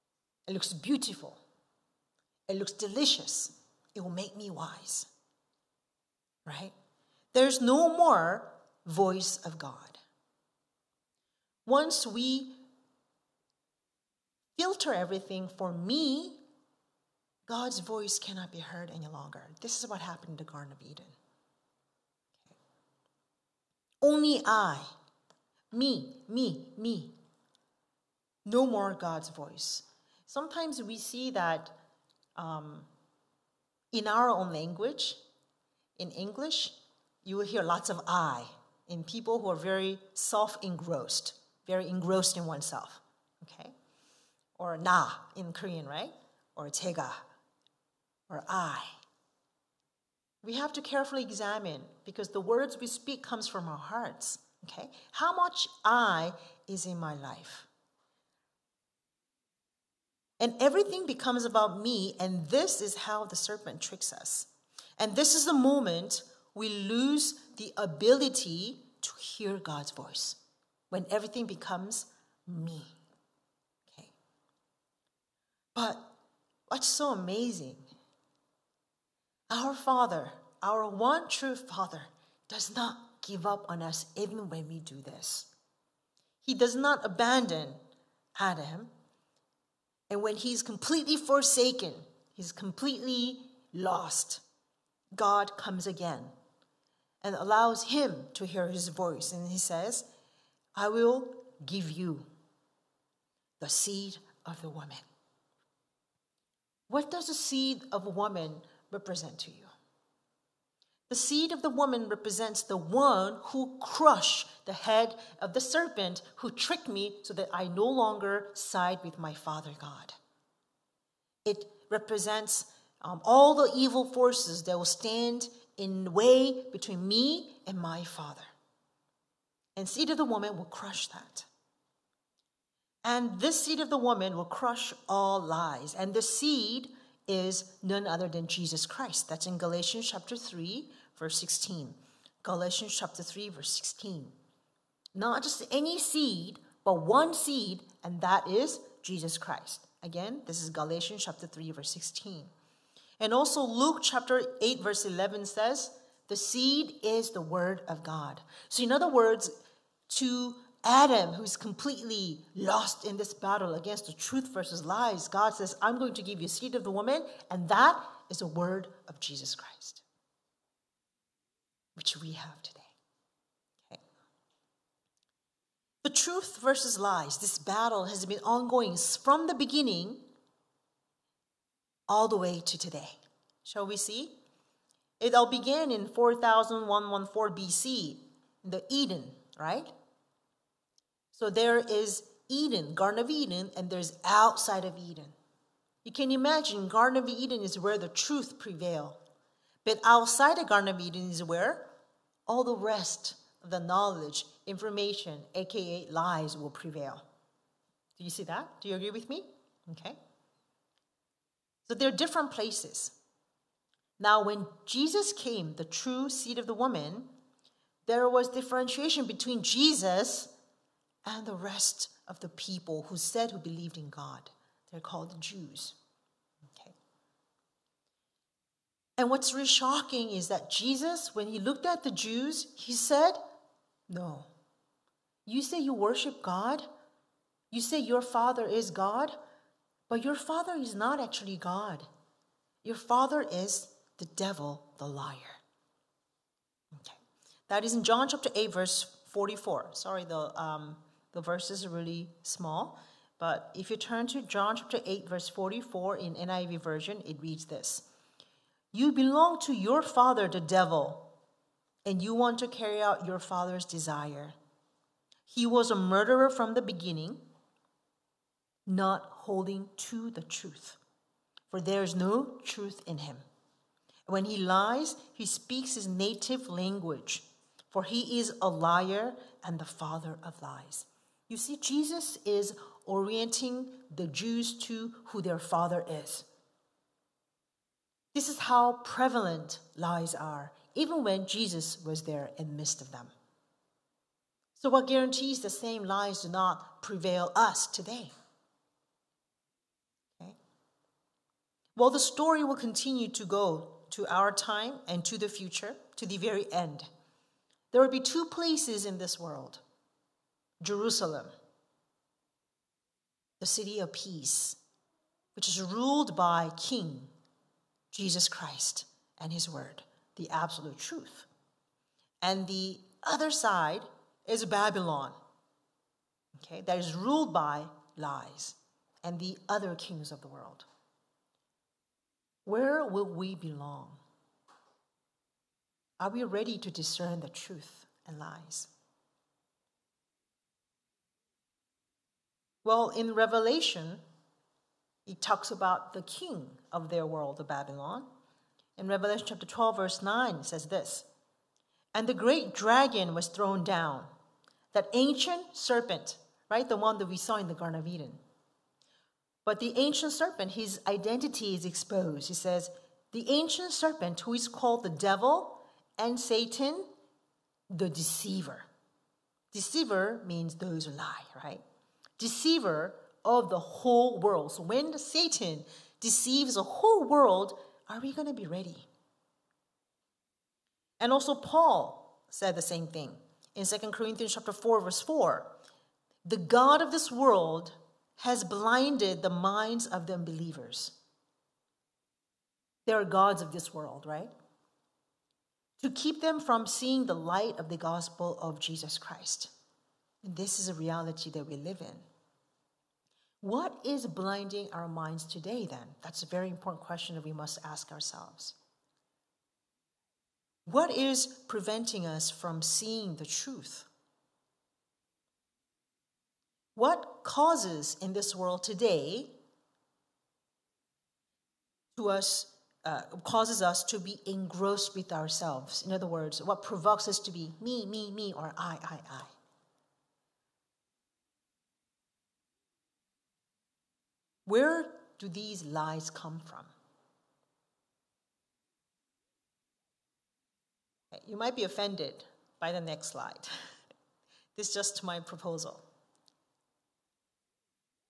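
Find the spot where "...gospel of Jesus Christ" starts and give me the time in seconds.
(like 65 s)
397 s.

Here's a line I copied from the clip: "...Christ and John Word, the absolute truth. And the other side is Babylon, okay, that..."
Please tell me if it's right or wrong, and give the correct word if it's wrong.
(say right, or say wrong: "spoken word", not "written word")
wrong: "His", not "John".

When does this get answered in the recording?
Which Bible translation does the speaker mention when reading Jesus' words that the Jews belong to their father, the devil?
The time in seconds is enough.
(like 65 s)
256 s.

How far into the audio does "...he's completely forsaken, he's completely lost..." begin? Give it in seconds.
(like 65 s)
90 s.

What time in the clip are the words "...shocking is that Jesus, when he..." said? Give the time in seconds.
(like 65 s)
229 s.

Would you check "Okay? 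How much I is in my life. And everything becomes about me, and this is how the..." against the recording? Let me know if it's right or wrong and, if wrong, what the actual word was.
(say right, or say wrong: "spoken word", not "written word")
right.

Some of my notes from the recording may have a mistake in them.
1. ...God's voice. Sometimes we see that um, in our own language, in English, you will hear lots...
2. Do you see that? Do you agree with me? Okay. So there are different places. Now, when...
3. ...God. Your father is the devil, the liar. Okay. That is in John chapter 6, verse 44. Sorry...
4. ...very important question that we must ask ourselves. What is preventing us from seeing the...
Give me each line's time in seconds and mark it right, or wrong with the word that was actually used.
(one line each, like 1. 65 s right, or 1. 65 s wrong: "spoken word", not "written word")
1. 28 s right
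2. 208 s right
3. 241 s wrong: "8", not "6"
4. 406 s right.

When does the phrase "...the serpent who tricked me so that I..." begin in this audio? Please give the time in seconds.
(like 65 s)
115 s.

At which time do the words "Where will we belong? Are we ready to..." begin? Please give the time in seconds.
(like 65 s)
332 s.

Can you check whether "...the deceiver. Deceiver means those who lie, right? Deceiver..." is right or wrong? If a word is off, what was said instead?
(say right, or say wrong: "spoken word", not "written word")
right.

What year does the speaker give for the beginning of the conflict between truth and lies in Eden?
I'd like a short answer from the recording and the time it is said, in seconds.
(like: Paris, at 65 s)
4114 BC, at 186 s.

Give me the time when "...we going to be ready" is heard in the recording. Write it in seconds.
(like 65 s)
378 s.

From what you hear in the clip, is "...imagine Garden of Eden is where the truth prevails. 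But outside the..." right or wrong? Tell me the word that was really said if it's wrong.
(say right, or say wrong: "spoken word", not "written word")
right.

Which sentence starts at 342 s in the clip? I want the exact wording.
Well, in Revelation, it talks about the king of their world of Babylon.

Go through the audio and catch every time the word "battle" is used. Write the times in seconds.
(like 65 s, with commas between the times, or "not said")
163 s, 177 s.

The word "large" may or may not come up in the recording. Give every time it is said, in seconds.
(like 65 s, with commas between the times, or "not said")
not said.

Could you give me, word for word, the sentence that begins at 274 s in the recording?
When he lies, he speaks his native language, for he is a liar and the father of lies.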